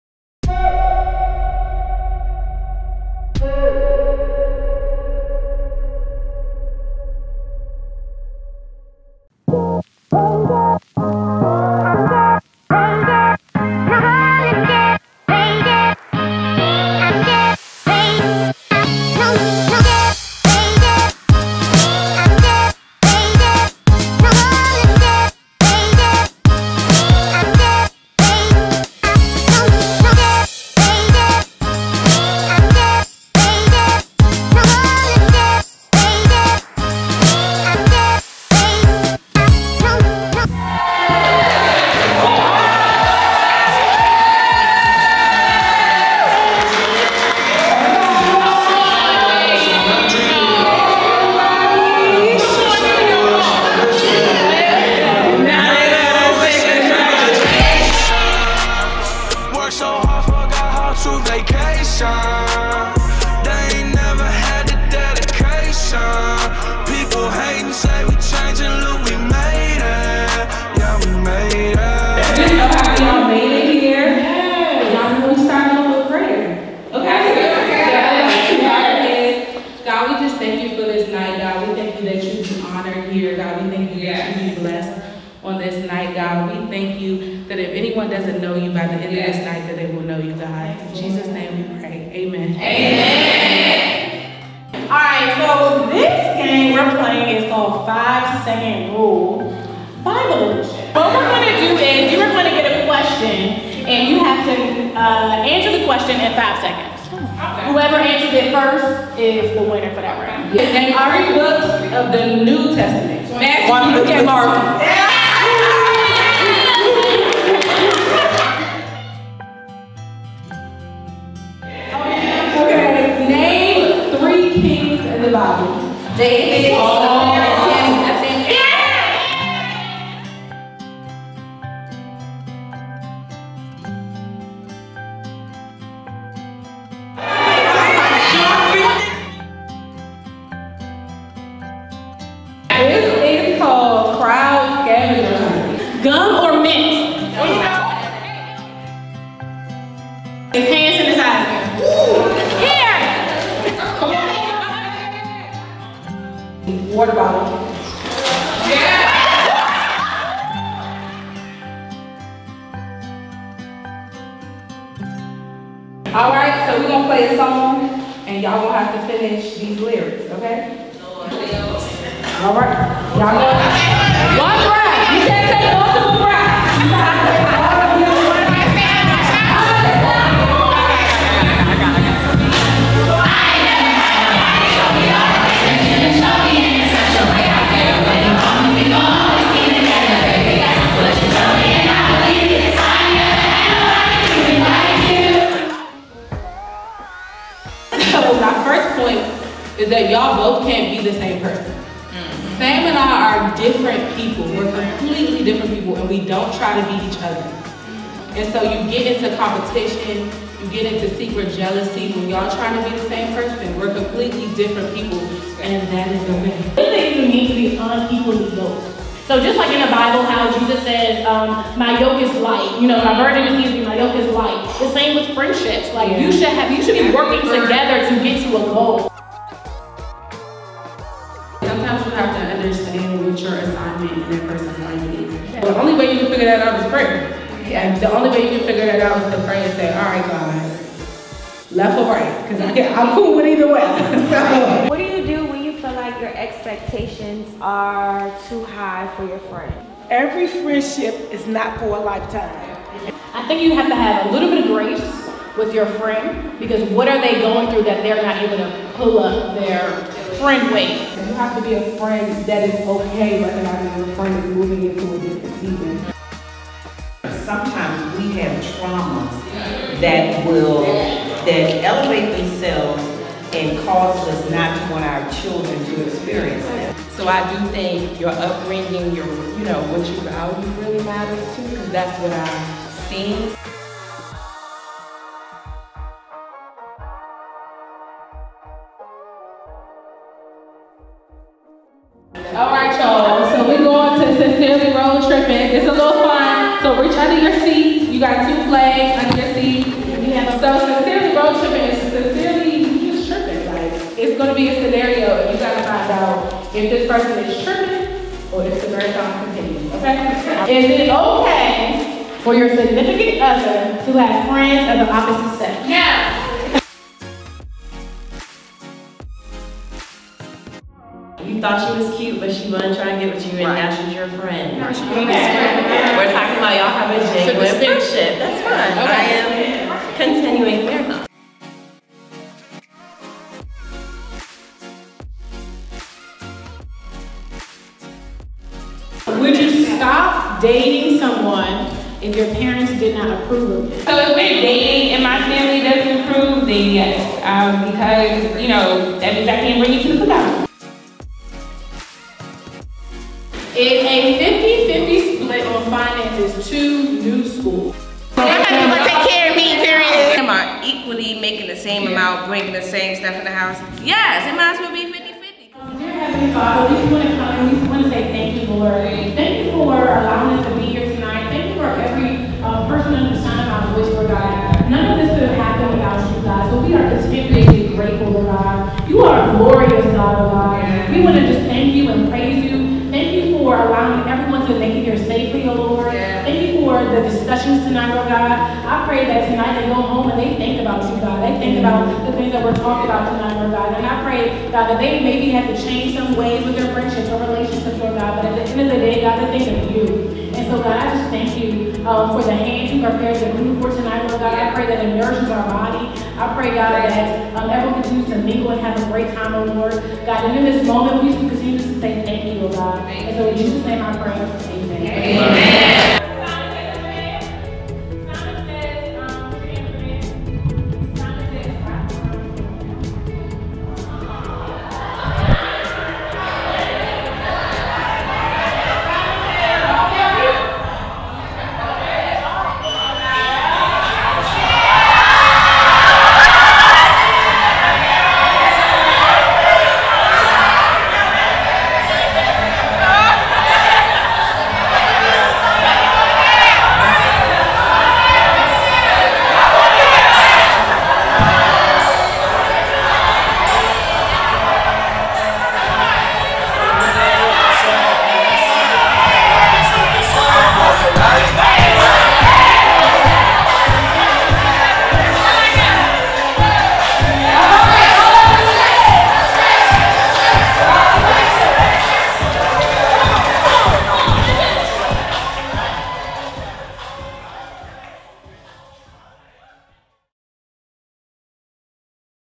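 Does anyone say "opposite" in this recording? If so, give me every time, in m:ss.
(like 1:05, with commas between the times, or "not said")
5:15.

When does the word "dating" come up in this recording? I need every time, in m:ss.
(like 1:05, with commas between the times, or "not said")
5:40, 5:44.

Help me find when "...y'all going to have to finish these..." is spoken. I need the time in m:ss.
2:48.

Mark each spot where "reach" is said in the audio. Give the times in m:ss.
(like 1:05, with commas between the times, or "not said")
4:57.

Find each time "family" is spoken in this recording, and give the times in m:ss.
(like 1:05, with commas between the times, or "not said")
5:45.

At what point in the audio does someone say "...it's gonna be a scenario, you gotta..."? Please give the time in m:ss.
5:04.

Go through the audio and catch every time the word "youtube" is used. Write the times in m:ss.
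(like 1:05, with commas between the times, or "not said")
not said.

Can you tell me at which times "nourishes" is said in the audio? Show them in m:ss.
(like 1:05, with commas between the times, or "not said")
6:45.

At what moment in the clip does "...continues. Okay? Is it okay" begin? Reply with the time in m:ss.
5:09.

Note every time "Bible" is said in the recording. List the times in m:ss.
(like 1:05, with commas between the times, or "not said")
1:40, 3:39.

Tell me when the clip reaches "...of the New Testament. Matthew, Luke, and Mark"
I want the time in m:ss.
1:51.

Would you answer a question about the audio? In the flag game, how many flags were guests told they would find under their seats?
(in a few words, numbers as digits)
2.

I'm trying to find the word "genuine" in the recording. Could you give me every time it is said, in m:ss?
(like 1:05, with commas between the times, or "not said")
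5:27.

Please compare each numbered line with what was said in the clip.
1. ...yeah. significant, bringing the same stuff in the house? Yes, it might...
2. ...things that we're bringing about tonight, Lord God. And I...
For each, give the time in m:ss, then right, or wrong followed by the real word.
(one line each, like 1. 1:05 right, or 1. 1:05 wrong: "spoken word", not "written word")
1. 6:02 wrong: "amount", not "significant"
2. 6:32 wrong: "talking", not "bringing".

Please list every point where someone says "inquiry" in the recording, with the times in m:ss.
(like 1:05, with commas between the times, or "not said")
not said.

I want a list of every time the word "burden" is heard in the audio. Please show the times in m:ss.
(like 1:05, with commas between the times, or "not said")
3:43.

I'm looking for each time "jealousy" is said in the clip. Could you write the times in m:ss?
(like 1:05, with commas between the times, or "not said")
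3:31.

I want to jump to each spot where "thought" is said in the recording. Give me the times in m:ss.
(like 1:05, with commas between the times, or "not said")
5:21.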